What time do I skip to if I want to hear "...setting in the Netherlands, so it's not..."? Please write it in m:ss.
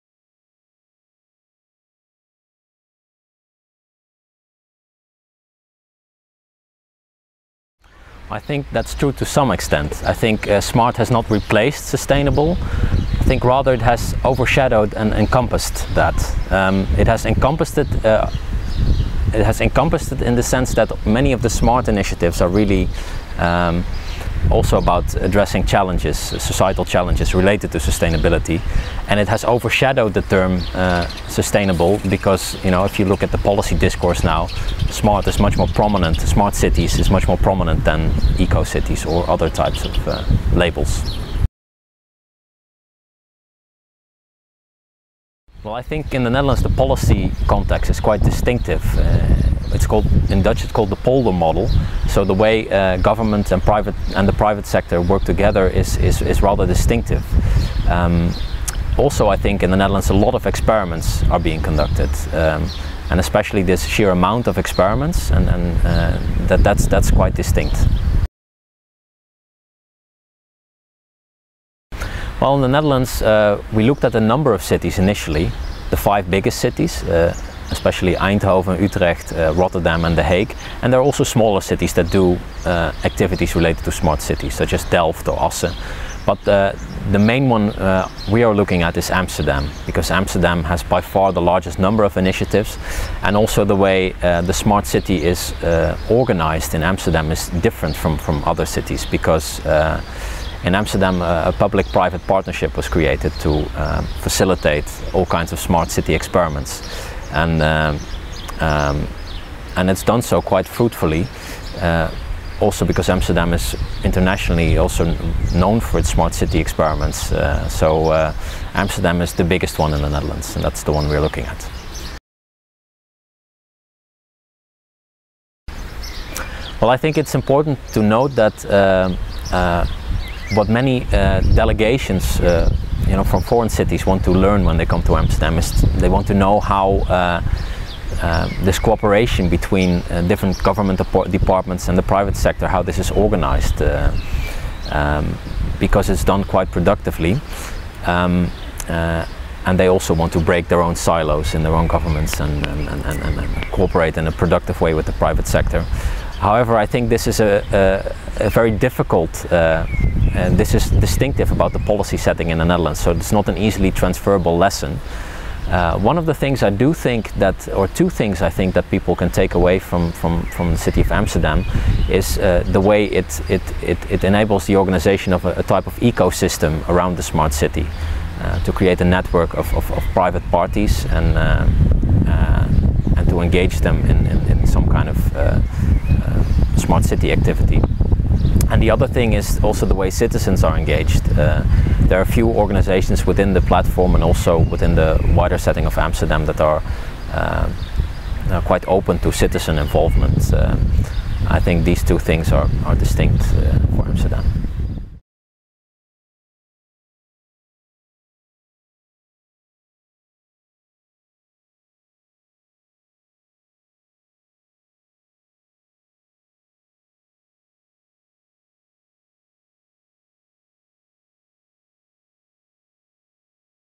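2:42.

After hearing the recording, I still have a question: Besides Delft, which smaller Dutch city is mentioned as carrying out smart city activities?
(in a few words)
Assen.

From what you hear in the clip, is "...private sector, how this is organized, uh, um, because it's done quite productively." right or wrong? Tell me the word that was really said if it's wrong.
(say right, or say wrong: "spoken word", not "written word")
right.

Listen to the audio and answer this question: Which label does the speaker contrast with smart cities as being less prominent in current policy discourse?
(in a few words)
eco cities.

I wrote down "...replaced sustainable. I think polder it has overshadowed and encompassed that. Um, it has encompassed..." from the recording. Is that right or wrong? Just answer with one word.
wrong.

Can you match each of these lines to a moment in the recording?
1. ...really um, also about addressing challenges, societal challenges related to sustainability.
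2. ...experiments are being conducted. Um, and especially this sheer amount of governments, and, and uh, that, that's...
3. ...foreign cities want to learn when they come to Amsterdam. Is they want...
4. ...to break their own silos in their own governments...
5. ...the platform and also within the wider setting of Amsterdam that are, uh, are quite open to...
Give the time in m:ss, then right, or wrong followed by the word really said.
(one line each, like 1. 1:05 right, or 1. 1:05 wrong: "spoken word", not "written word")
1. 0:22 right
2. 1:00 wrong: "experiments", not "governments"
3. 2:13 right
4. 2:30 right
5. 3:13 right.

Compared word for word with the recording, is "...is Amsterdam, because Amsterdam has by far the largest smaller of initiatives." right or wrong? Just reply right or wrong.
wrong.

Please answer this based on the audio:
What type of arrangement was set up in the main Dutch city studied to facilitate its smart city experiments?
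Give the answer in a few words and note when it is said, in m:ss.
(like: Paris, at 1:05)
public-private partnership, at 1:41.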